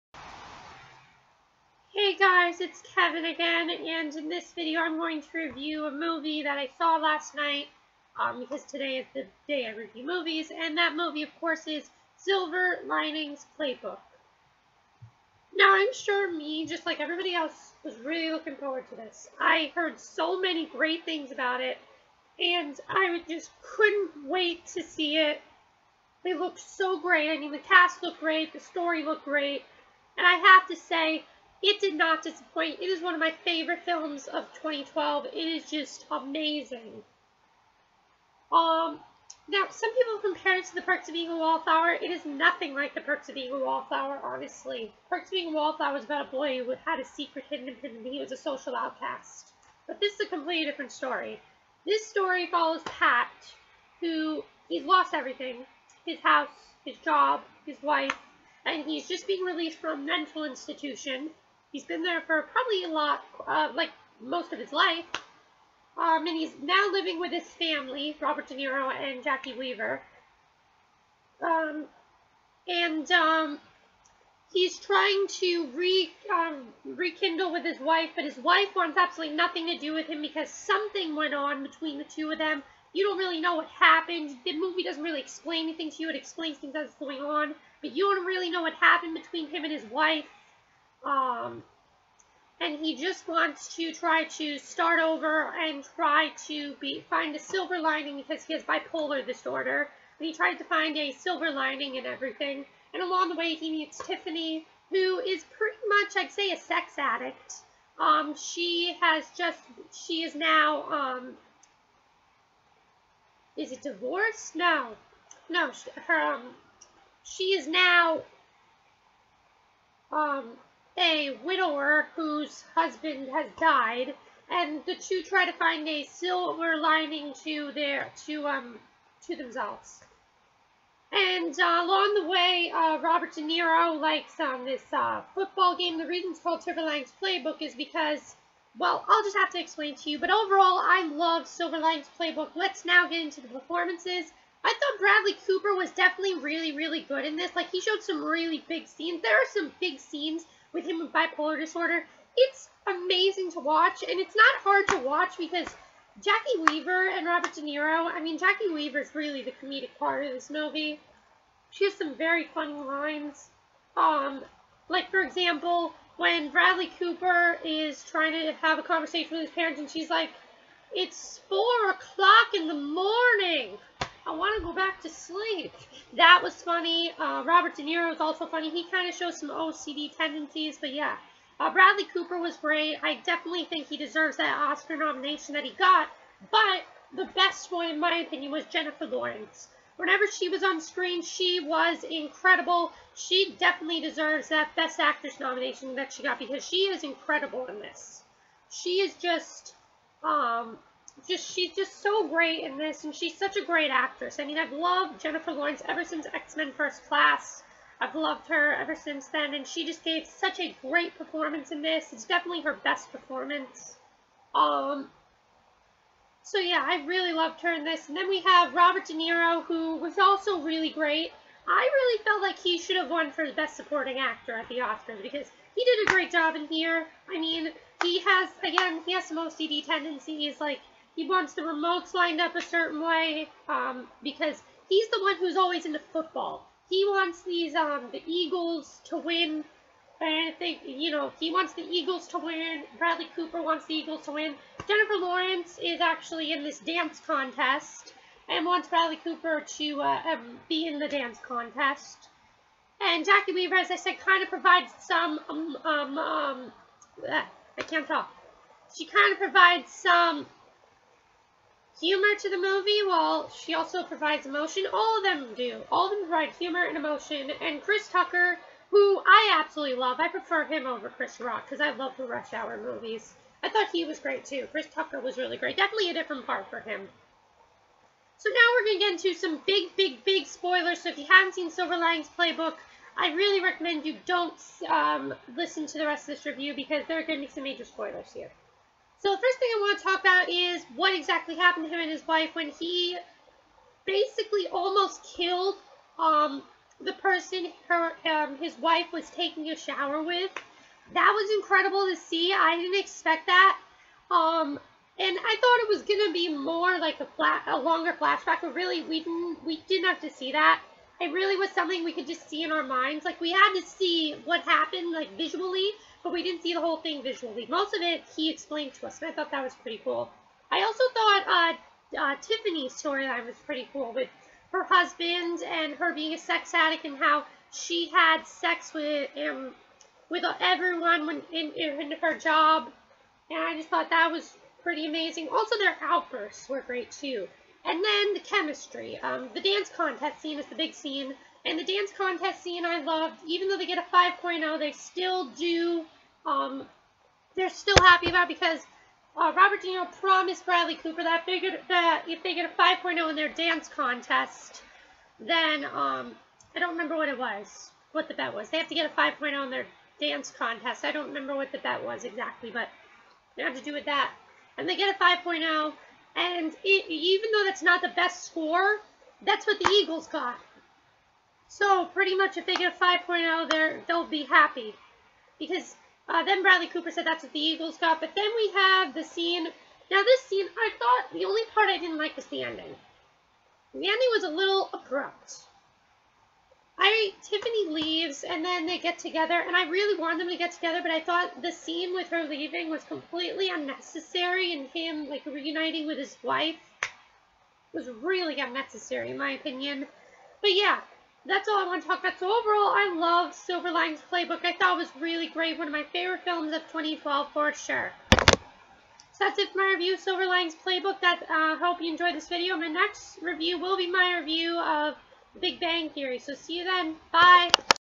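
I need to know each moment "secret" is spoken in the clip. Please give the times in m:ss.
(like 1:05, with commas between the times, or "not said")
0:47.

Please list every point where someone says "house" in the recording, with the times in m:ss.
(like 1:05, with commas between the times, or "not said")
0:56.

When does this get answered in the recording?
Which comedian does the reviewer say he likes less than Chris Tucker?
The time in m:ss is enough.
4:31.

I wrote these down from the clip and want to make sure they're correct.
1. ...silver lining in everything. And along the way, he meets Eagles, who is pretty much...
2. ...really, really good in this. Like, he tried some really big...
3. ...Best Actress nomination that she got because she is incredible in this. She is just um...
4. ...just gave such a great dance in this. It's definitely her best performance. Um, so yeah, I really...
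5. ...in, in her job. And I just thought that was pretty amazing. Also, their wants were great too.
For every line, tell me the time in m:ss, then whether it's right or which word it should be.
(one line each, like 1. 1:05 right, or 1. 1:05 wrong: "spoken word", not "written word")
1. 1:41 wrong: "Tiffany", not "Eagles"
2. 2:26 wrong: "showed", not "tried"
3. 3:14 right
4. 3:29 wrong: "performance", not "dance"
5. 5:31 wrong: "outbursts", not "wants".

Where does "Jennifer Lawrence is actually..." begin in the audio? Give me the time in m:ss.
4:04.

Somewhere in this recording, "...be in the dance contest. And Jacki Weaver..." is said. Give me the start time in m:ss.
4:10.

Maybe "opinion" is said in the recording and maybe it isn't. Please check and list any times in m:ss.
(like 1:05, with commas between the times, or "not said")
3:08, 6:39.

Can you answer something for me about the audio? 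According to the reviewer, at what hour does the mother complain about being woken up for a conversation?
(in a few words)
4 o'clock in the morning.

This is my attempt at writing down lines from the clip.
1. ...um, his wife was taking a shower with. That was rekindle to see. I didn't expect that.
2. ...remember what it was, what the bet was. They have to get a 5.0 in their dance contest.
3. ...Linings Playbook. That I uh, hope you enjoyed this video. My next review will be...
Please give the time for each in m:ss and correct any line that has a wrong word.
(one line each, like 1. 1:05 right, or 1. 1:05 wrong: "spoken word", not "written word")
1. 4:58 wrong: "incredible", not "rekindle"
2. 5:56 right
3. 6:50 right.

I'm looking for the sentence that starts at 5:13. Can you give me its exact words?
Like we had to see what happened like visually, but we didn't see the whole thing visually.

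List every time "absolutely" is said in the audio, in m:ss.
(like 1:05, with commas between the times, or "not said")
1:18, 4:29.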